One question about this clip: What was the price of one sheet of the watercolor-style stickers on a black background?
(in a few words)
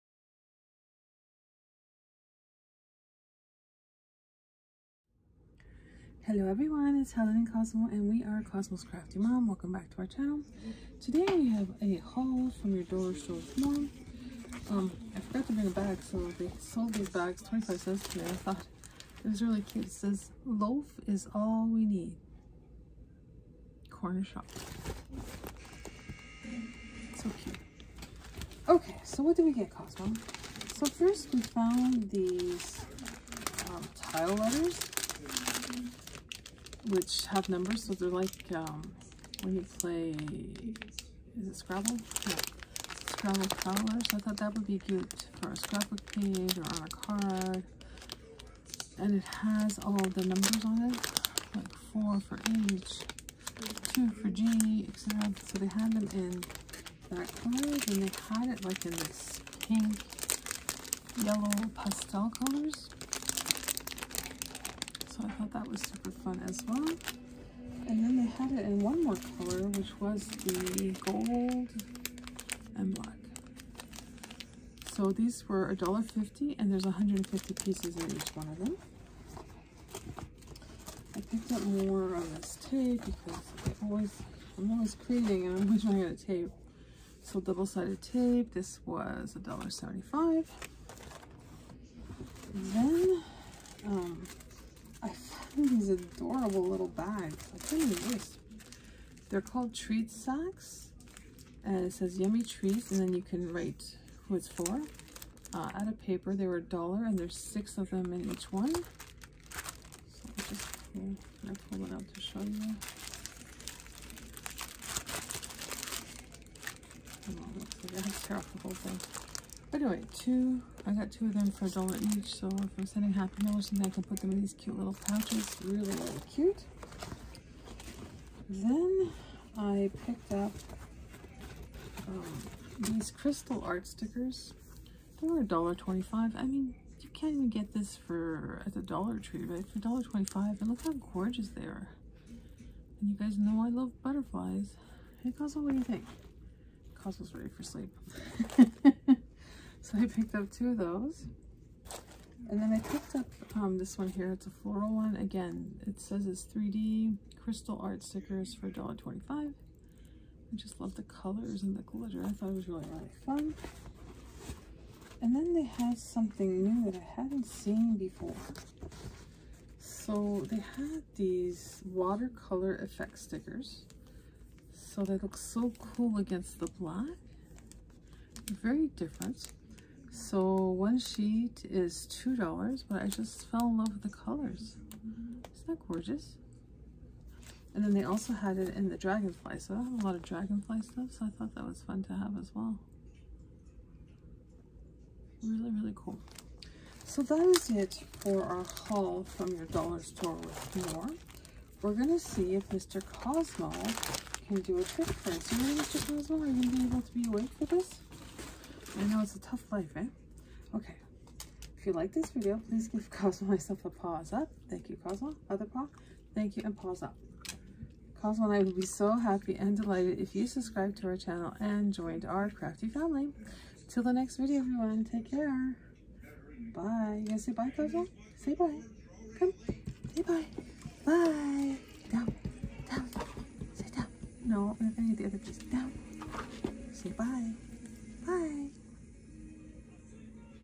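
$2.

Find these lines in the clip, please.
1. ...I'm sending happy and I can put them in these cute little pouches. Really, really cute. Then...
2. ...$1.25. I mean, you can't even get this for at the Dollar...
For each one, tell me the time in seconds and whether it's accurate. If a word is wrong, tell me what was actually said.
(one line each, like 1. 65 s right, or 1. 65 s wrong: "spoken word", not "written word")
1. 122 s right
2. 135 s right.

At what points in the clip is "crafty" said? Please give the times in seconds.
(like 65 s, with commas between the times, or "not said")
8 s, 222 s.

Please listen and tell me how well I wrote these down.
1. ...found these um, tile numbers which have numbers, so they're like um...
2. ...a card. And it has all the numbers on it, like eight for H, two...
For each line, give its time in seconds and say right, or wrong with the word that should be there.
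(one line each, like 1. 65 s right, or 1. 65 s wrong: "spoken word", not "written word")
1. 31 s wrong: "letters", not "numbers"
2. 46 s wrong: "four", not "eight".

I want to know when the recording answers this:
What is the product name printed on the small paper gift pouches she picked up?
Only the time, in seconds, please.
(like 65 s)
99 s.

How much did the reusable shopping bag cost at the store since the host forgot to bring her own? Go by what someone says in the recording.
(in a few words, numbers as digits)
25 cents.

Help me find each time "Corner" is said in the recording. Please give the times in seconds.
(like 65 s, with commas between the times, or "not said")
23 s.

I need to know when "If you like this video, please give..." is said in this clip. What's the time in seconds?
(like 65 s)
211 s.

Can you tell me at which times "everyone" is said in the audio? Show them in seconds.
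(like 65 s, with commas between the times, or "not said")
6 s, 224 s.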